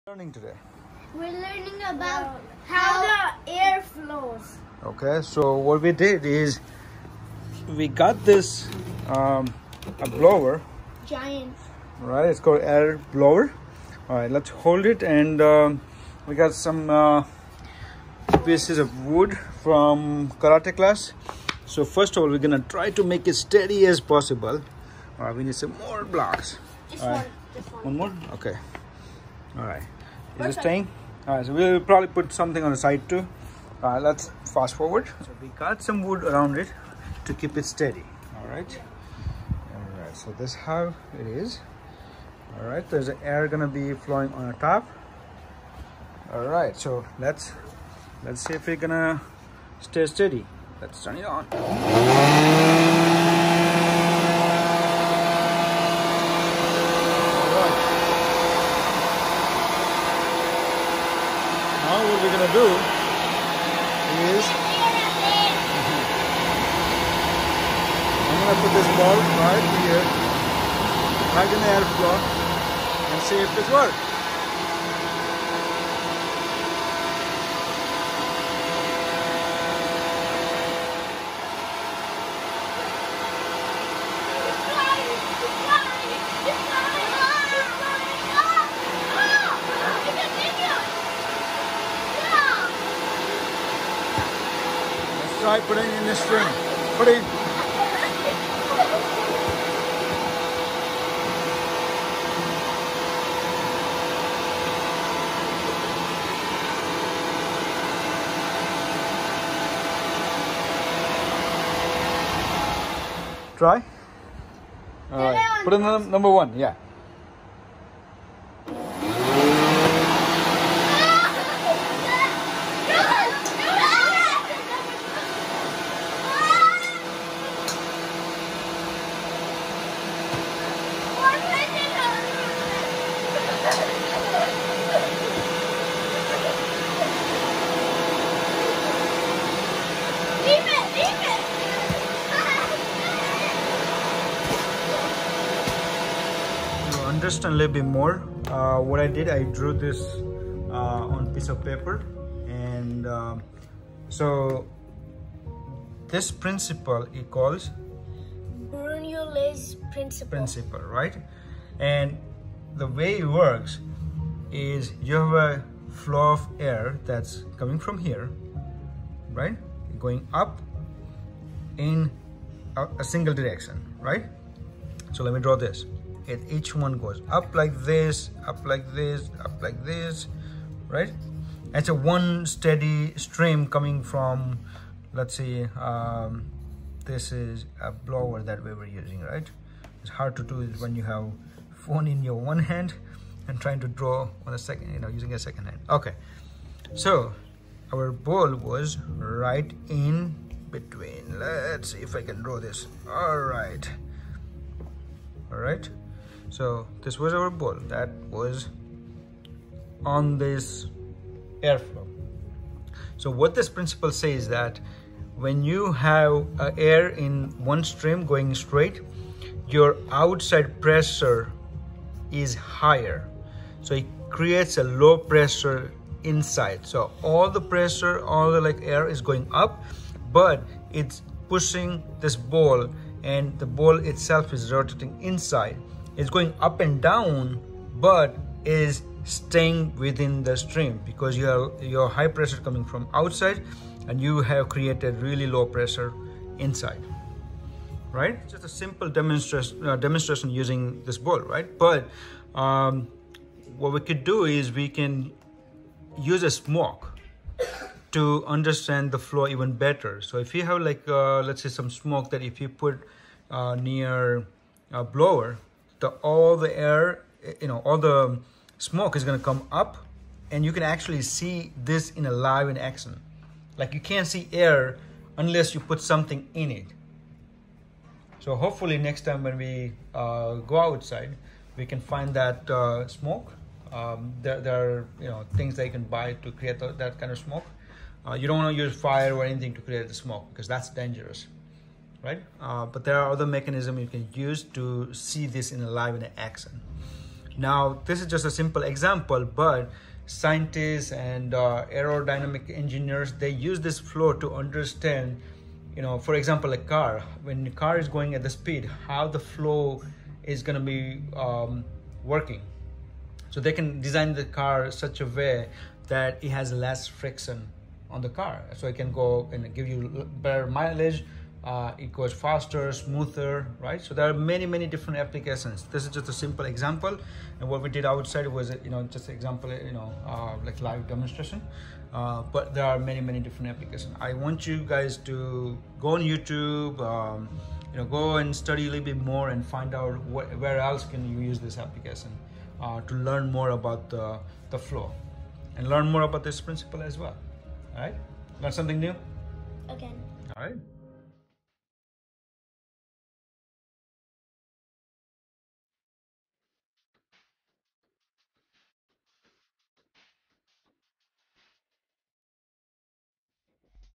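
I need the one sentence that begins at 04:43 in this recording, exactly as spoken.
Um, there, there, are you know things that you can buy to create that kind of smoke.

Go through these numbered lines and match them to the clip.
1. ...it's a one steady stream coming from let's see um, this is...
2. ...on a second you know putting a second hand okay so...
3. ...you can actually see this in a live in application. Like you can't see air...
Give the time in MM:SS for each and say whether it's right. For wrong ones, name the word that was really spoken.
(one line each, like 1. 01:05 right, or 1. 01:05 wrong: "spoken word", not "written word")
1. 03:01 right
2. 03:14 wrong: "using", not "putting"
3. 04:30 wrong: "action", not "application".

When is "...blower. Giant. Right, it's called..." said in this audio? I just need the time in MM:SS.
00:10.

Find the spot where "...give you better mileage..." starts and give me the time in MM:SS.
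05:19.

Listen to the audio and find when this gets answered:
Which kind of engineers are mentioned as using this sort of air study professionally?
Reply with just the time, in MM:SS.
05:01.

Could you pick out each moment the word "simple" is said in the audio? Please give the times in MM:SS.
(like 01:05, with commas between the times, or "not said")
04:08, 04:58, 05:26.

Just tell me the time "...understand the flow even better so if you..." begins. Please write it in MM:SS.
04:18.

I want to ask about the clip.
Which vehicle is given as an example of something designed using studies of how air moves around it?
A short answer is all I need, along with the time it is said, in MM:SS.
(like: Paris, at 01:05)
a car, at 05:06.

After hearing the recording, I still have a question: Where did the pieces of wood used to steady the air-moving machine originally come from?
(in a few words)
karate class.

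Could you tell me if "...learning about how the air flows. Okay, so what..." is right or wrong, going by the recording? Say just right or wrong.
right.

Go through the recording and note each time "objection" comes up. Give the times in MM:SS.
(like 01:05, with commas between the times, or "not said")
not said.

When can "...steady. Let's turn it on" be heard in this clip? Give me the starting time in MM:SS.
00:50.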